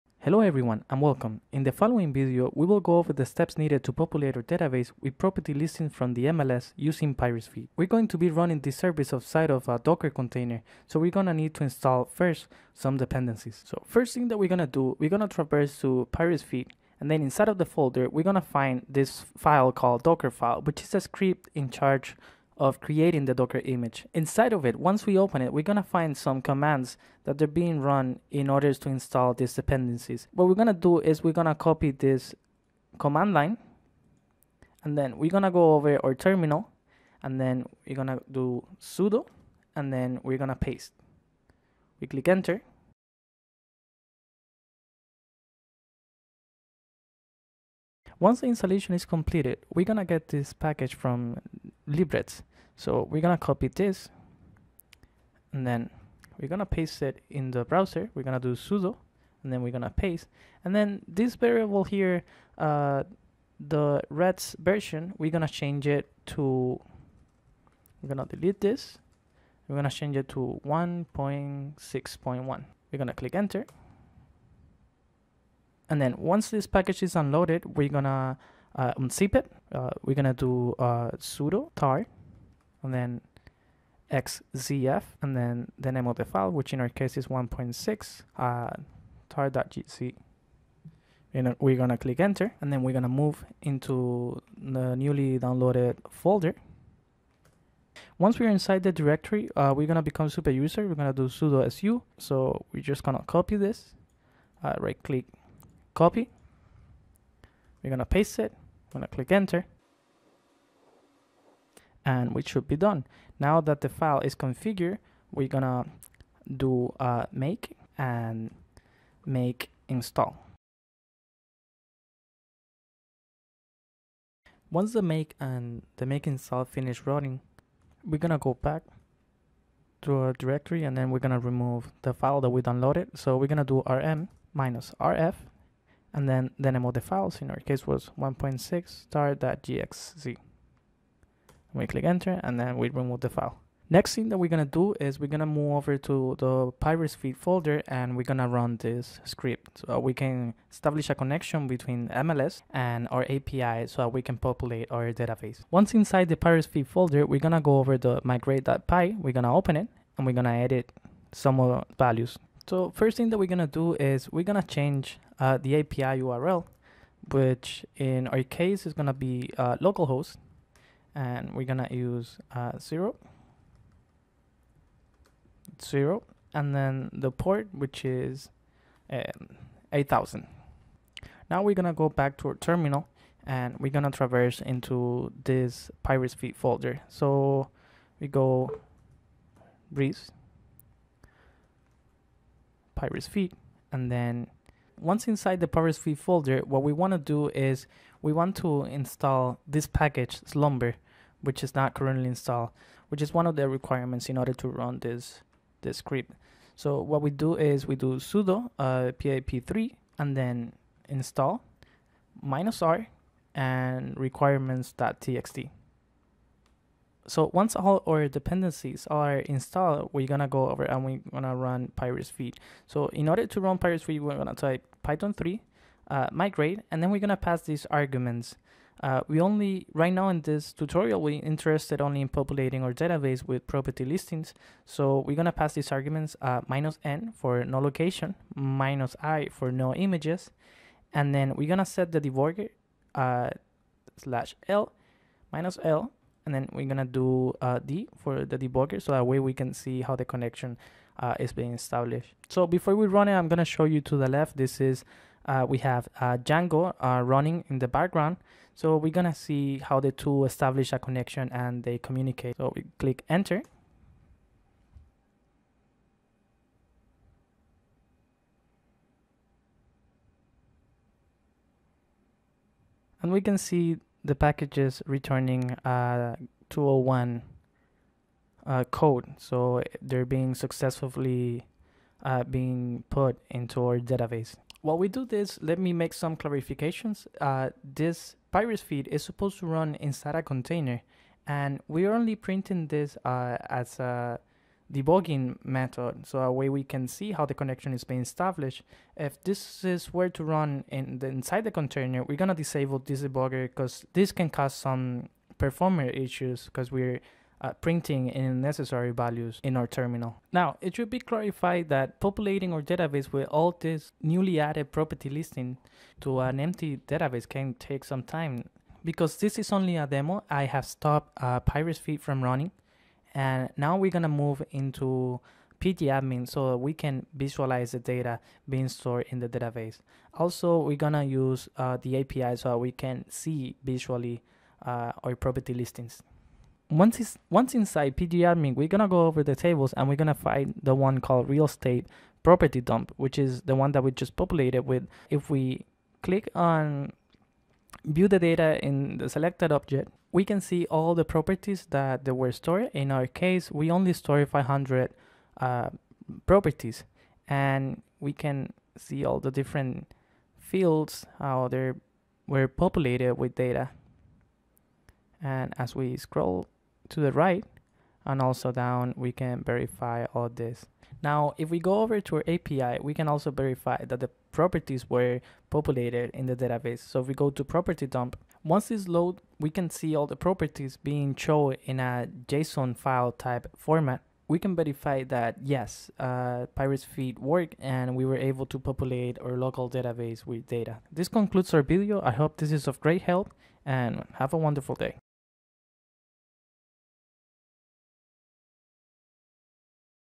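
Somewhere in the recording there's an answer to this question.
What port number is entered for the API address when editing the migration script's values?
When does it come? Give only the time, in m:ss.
2:59.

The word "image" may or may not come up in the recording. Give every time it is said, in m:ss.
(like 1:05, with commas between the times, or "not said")
0:23, 3:59.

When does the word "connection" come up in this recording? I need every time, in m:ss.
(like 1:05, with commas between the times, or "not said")
2:31, 4:10, 4:20, 4:57.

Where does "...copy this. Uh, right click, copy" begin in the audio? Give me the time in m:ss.
1:43.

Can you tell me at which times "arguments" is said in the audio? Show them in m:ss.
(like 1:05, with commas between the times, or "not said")
3:47, 3:55.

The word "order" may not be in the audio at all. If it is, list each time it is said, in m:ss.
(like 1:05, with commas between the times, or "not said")
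0:28, 3:24, 3:43.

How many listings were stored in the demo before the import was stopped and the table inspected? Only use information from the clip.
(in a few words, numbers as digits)
500.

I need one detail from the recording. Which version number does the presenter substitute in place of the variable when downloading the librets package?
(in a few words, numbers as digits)
1.6.1.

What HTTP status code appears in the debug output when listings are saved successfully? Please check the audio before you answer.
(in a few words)
201.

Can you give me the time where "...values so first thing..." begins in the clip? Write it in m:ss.
2:41.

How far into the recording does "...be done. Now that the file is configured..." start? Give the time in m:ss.
1:52.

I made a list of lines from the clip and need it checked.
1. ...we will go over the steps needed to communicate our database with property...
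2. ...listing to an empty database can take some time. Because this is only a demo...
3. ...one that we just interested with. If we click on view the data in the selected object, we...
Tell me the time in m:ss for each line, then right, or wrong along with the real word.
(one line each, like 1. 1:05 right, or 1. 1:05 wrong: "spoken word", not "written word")
1. 0:02 wrong: "populate", not "communicate"
2. 5:15 right
3. 5:43 wrong: "populated", not "interested".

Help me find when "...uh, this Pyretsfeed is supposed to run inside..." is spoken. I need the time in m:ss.
4:47.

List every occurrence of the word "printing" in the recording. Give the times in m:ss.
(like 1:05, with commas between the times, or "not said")
4:52, 5:07.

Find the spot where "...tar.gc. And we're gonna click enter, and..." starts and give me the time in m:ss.
1:29.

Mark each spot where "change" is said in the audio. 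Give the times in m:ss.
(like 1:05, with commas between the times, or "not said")
1:05, 1:09, 2:44.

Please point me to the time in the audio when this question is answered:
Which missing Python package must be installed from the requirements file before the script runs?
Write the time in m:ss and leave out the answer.
3:20.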